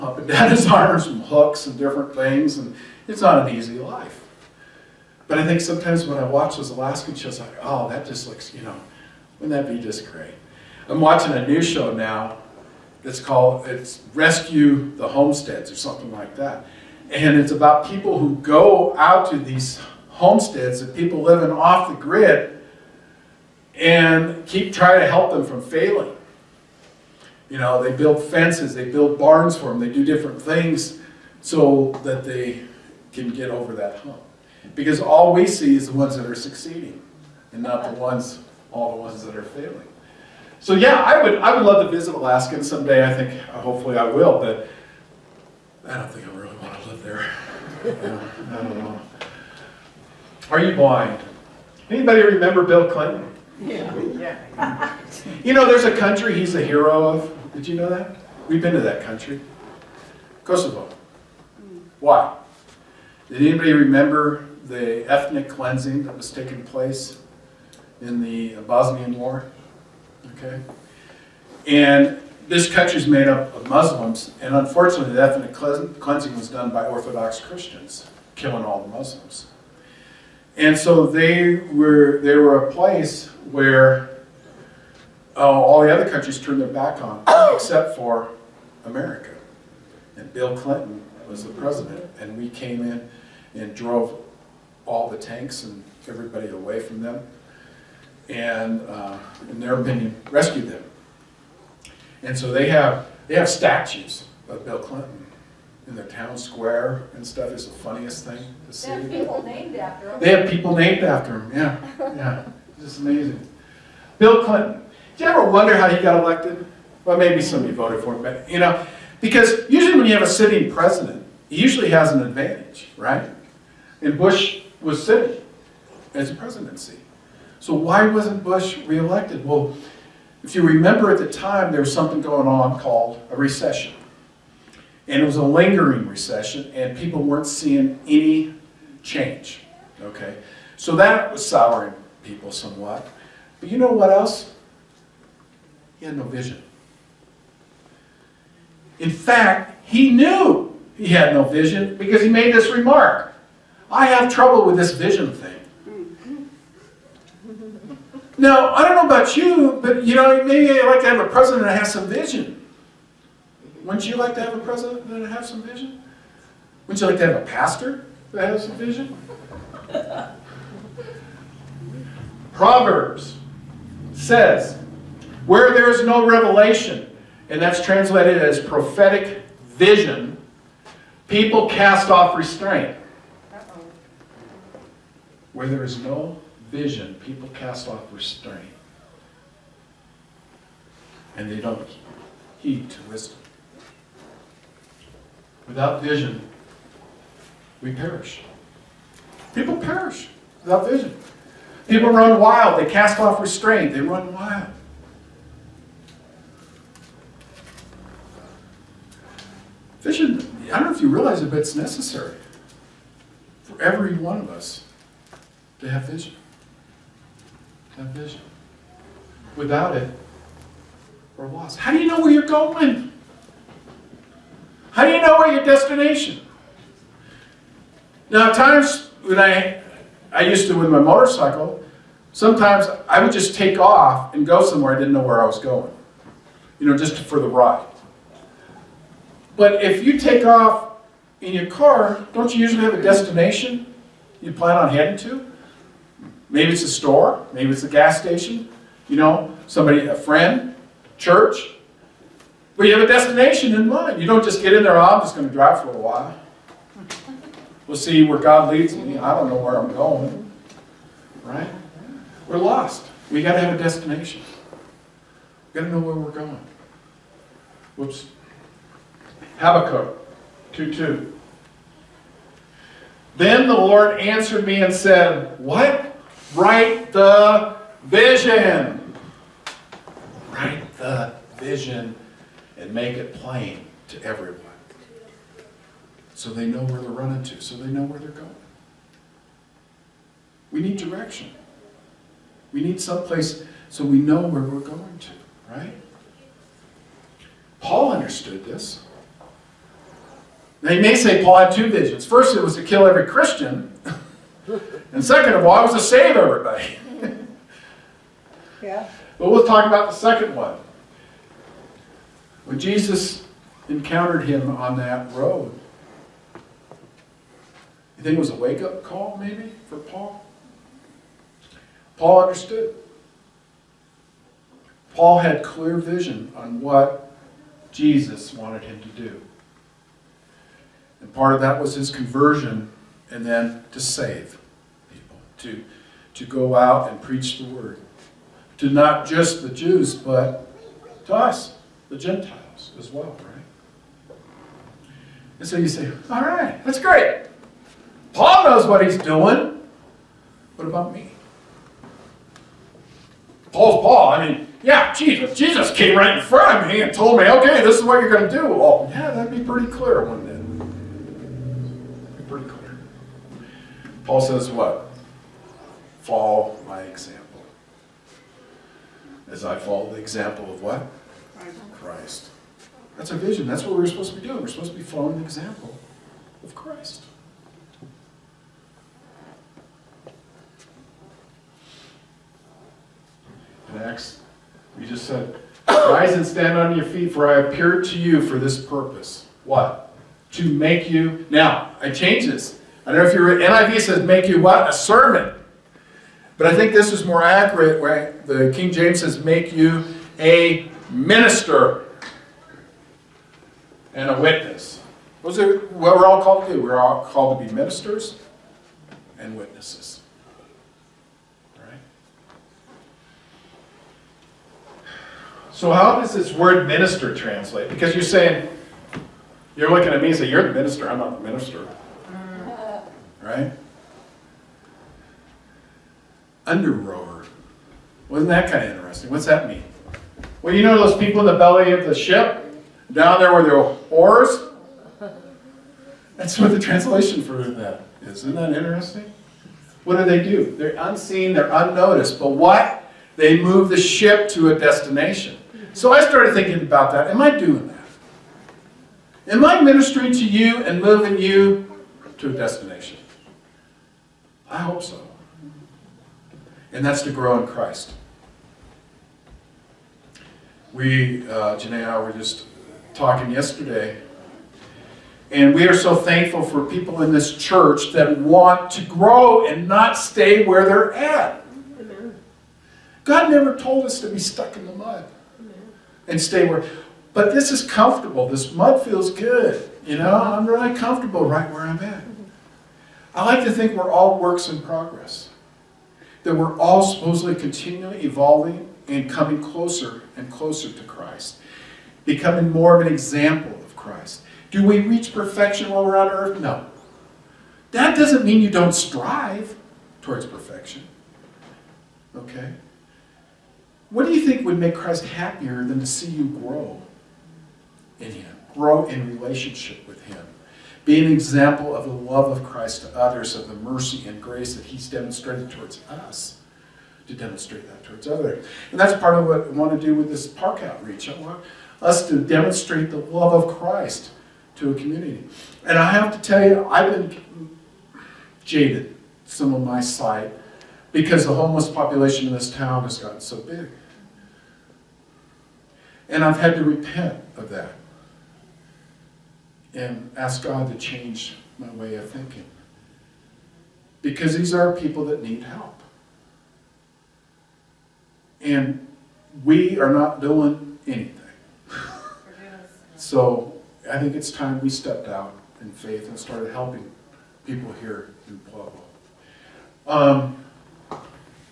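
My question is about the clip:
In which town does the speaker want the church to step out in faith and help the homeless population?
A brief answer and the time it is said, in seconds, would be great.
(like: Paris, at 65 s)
Pueblo, at 558 s.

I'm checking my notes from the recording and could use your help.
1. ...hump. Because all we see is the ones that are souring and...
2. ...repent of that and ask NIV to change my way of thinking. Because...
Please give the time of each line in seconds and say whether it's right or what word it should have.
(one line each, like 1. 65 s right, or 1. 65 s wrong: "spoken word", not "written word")
1. 33 s wrong: "succeeding", not "souring"
2. 536 s wrong: "God", not "NIV".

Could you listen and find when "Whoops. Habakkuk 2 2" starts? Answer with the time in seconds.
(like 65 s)
267 s.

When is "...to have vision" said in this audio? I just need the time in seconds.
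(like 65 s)
215 s.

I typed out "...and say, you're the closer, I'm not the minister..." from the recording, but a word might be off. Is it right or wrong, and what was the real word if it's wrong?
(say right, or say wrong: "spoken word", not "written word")
wrong: "minister", not "closer".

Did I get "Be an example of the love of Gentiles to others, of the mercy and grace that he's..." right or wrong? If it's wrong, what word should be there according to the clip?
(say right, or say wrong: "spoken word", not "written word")
wrong: "Christ", not "Gentiles".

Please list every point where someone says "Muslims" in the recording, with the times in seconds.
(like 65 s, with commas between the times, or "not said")
73 s, 78 s.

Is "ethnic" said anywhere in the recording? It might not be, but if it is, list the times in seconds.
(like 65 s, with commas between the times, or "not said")
65 s, 75 s.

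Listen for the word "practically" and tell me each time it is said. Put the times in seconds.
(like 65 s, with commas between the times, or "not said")
not said.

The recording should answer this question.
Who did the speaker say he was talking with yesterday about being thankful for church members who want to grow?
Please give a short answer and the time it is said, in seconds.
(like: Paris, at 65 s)
Janae, at 461 s.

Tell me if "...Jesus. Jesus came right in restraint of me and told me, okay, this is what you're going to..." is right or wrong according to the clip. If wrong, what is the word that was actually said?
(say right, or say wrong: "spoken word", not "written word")
wrong: "front", not "restraint".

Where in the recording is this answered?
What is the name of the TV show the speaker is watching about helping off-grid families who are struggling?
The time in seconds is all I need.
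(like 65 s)
14 s.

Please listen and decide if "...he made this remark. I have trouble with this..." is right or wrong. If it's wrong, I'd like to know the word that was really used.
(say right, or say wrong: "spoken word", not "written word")
right.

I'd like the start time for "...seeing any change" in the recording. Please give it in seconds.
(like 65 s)
137 s.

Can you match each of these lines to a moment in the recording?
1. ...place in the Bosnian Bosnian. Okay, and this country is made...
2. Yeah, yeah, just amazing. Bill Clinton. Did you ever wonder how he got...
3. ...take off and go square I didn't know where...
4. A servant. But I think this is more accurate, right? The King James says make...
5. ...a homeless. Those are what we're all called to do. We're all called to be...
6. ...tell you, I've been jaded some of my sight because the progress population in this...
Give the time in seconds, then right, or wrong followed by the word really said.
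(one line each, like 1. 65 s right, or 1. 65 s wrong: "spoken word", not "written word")
1. 66 s wrong: "War", not "Bosnian"
2. 111 s right
3. 233 s wrong: "somewhere", not "square"
4. 394 s right
5. 404 s wrong: "witness", not "homeless"
6. 526 s wrong: "homeless", not "progress".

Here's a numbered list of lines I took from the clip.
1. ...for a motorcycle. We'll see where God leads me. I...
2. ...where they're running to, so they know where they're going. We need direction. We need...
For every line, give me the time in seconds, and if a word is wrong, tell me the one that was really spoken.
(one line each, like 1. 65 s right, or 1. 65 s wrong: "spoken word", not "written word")
1. 255 s wrong: "while", not "motorcycle"
2. 286 s right.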